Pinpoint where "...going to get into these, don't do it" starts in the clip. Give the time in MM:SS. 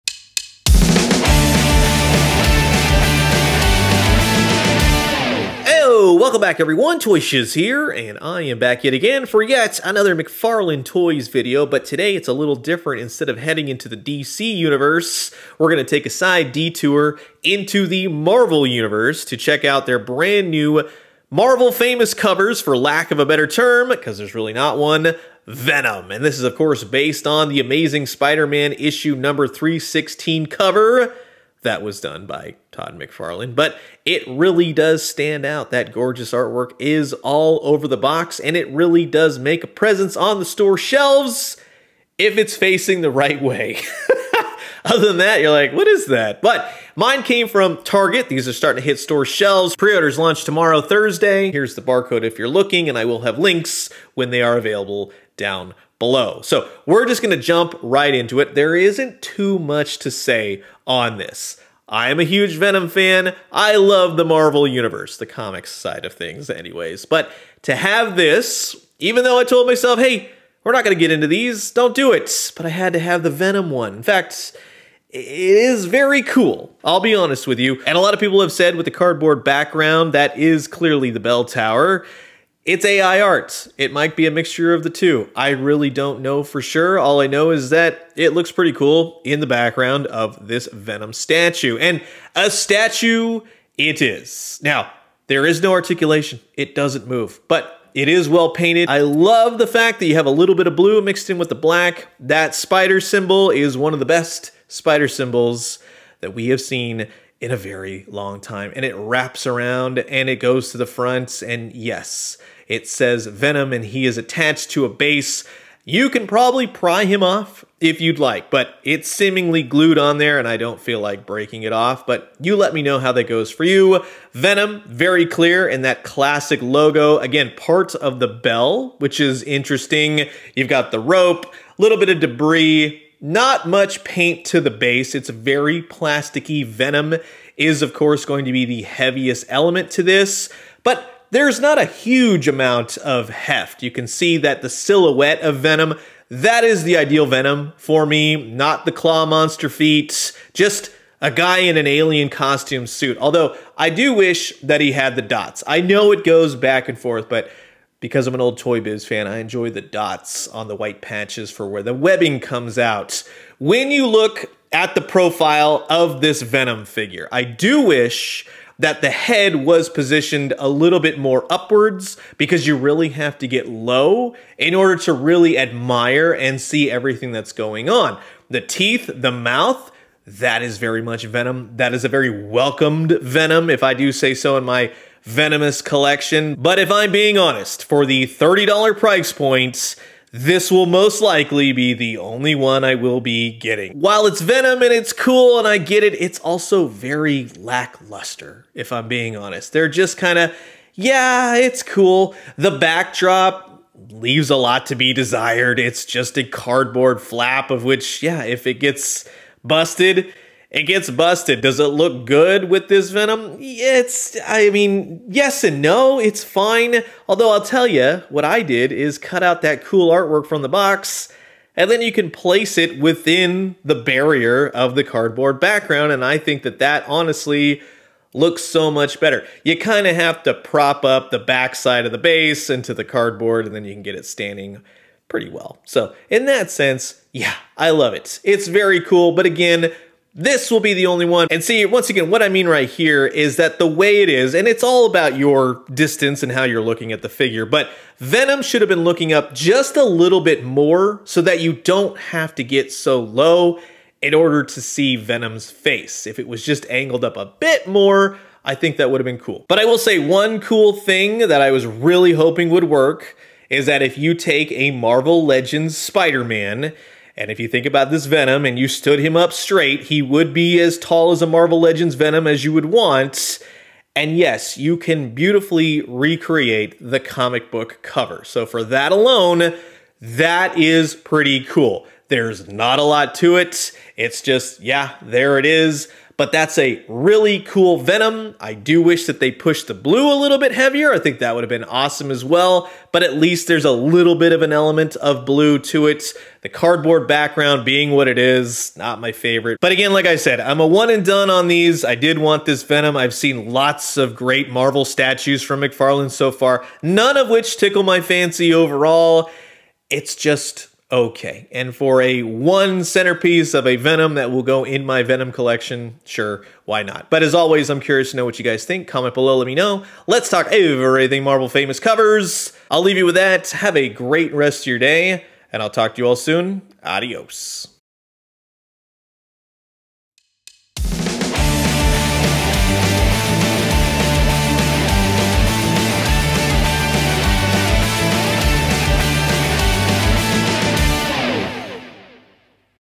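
01:10.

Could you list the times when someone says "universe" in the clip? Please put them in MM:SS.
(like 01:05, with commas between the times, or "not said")
00:14, 00:18, 01:04.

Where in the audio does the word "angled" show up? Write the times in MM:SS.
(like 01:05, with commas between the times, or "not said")
04:16.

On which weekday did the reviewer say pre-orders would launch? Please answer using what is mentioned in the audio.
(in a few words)
Thursday.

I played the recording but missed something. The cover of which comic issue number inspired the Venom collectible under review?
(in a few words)
316.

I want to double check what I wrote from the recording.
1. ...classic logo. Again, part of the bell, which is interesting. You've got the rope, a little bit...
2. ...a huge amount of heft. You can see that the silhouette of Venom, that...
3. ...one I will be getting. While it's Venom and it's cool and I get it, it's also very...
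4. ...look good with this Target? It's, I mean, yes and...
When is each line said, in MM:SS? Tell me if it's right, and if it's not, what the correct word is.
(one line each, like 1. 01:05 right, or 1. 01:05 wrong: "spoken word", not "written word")
1. 02:06 right
2. 02:21 right
3. 03:12 right
4. 03:31 wrong: "Venom", not "Target".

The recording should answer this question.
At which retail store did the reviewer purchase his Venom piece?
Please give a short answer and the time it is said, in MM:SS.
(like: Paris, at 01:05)
Target, at 00:47.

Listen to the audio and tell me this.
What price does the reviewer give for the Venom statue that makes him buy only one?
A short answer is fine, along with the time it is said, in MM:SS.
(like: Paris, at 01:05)
$30, at 03:08.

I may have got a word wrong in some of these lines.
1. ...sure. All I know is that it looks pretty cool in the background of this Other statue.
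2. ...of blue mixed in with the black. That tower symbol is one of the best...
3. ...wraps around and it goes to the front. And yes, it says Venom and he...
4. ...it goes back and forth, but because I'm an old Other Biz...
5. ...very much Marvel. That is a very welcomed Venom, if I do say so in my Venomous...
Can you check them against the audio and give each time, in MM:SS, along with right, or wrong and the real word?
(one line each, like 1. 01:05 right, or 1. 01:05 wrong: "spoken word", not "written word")
1. 01:26 wrong: "Venom", not "Other"
2. 01:40 wrong: "spider", not "tower"
3. 01:48 right
4. 02:36 wrong: "Toy", not "Other"
5. 03:00 wrong: "Venom", not "Marvel".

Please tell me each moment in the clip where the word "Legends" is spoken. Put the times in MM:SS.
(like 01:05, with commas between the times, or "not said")
04:25, 04:31.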